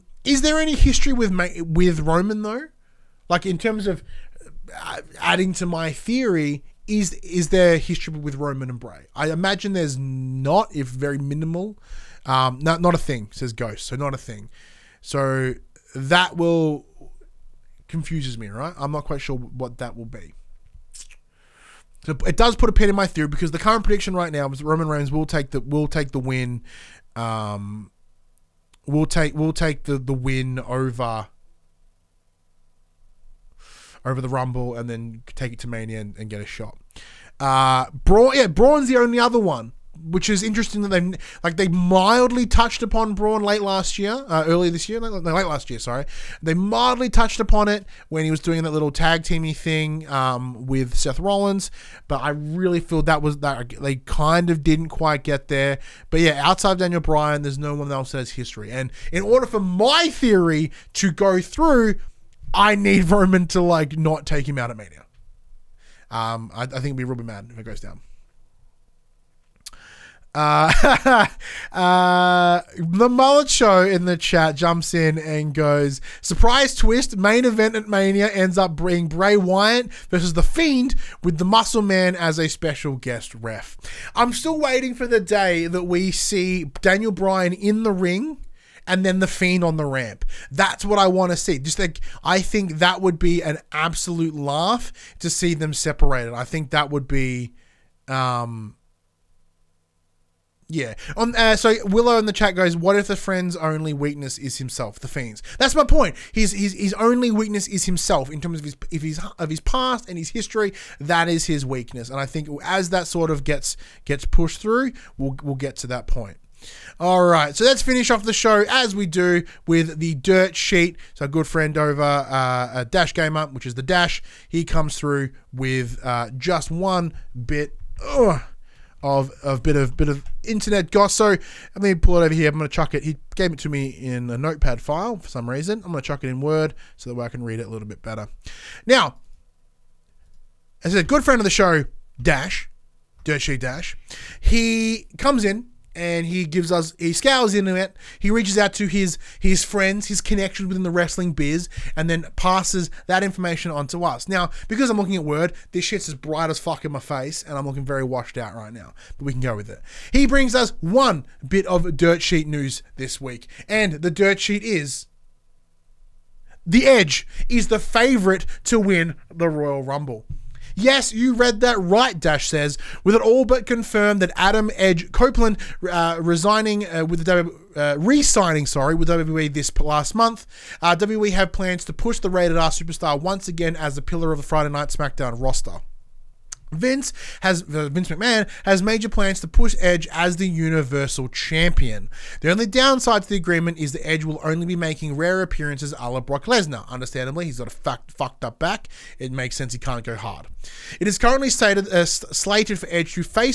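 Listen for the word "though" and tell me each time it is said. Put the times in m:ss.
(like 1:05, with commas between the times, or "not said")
0:02.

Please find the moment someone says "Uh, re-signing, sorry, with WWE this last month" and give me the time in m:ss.
2:57.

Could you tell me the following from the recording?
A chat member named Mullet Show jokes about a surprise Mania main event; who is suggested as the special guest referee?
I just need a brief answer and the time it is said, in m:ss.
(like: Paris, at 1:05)
The Muscle Man, at 1:21.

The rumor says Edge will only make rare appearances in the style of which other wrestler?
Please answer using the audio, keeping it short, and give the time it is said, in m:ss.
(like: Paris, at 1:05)
Brock Lesnar, at 3:16.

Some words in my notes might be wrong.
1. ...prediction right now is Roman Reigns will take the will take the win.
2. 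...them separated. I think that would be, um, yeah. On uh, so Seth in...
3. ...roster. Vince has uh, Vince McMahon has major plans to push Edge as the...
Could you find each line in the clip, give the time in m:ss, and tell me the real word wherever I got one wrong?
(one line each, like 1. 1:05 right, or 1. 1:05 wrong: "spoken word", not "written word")
1. 0:23 right
2. 1:35 wrong: "Willow", not "Seth"
3. 3:05 right.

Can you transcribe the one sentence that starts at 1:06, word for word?
Um, I, I think it'd be really mad if it goes down.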